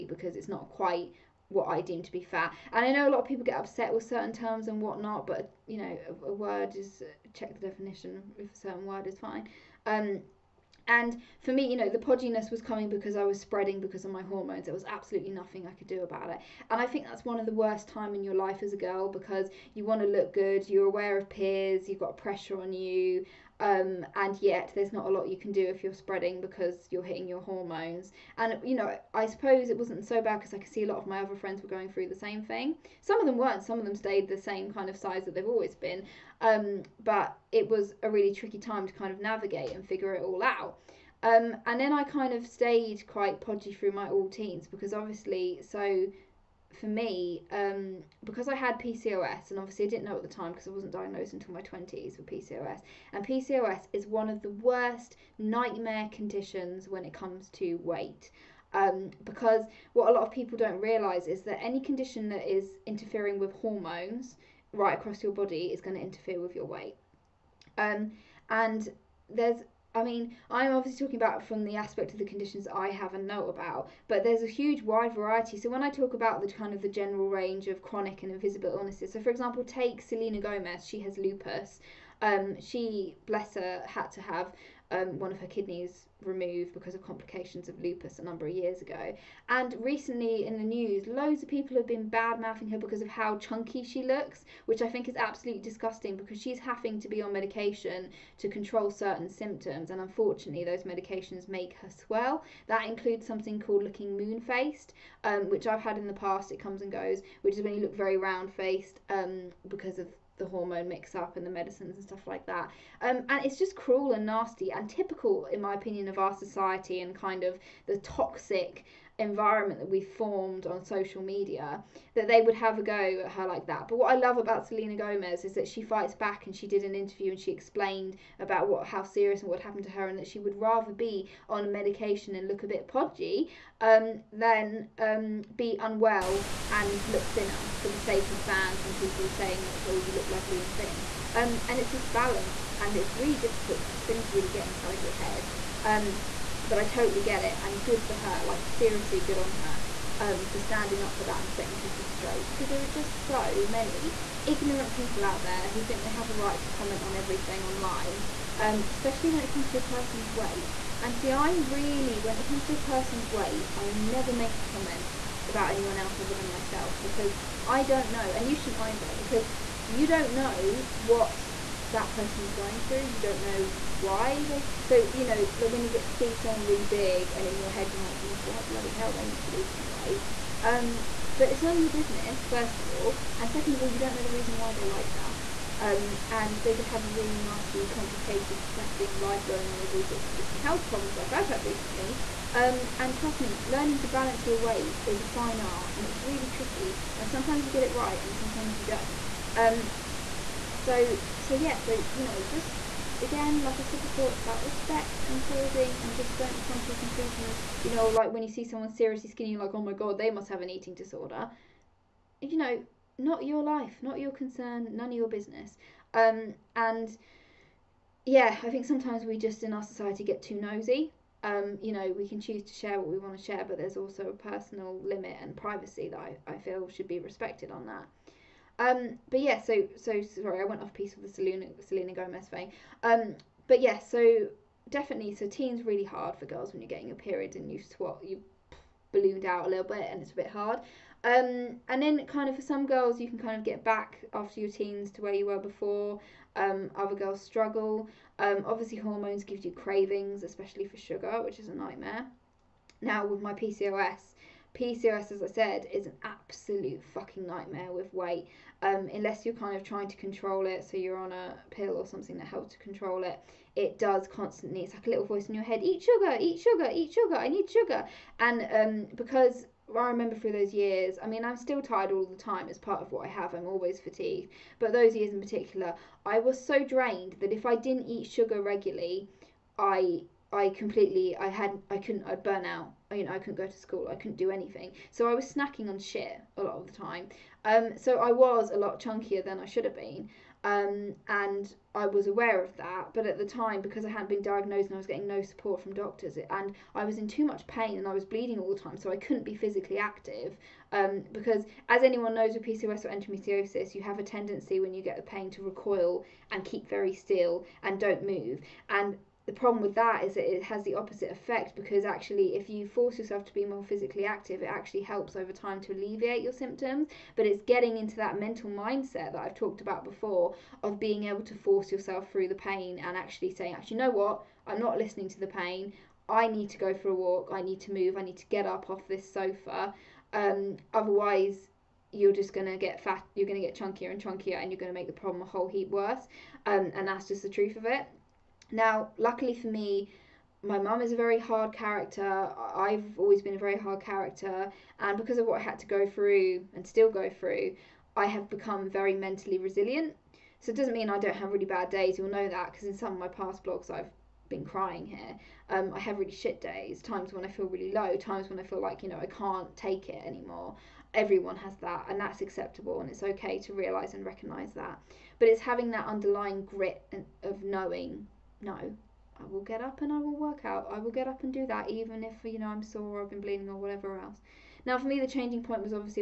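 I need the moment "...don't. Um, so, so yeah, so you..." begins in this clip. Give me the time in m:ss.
3:18.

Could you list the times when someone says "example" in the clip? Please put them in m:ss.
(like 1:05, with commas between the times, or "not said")
1:19.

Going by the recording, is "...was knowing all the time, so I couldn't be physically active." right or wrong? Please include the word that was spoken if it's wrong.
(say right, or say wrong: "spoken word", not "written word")
wrong: "bleeding", not "knowing".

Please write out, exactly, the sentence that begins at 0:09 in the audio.
Um, and for me, you know, the podginess was coming because I was spreading because of my hormones.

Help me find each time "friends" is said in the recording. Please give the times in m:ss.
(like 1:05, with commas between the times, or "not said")
0:31.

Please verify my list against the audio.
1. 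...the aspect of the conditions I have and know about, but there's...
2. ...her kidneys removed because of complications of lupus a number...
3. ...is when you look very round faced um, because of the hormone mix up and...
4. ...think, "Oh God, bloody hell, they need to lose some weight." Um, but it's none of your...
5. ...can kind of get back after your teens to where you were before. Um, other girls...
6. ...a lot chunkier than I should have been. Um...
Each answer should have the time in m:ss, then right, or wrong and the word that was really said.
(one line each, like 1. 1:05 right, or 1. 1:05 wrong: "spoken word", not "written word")
1. 1:11 right
2. 1:25 right
3. 1:47 right
4. 2:58 right
5. 4:03 right
6. 4:48 right.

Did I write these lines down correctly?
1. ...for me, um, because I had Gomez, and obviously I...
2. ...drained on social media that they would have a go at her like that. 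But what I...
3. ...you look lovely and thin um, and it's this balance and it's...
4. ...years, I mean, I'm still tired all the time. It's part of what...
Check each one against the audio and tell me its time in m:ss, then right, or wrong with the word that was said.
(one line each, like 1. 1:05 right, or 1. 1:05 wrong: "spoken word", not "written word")
1. 0:46 wrong: "PCOS", not "Gomez"
2. 2:00 wrong: "formed", not "drained"
3. 2:20 right
4. 4:30 right.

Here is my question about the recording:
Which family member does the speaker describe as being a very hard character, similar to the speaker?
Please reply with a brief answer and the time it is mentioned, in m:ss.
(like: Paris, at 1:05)
my mum, at 5:40.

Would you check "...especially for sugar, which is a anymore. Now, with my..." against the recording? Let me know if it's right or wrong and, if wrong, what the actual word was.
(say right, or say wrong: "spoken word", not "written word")
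wrong: "nightmare", not "anymore".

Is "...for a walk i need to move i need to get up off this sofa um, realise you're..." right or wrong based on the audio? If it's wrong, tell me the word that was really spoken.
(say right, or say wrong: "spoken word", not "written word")
wrong: "otherwise", not "realise".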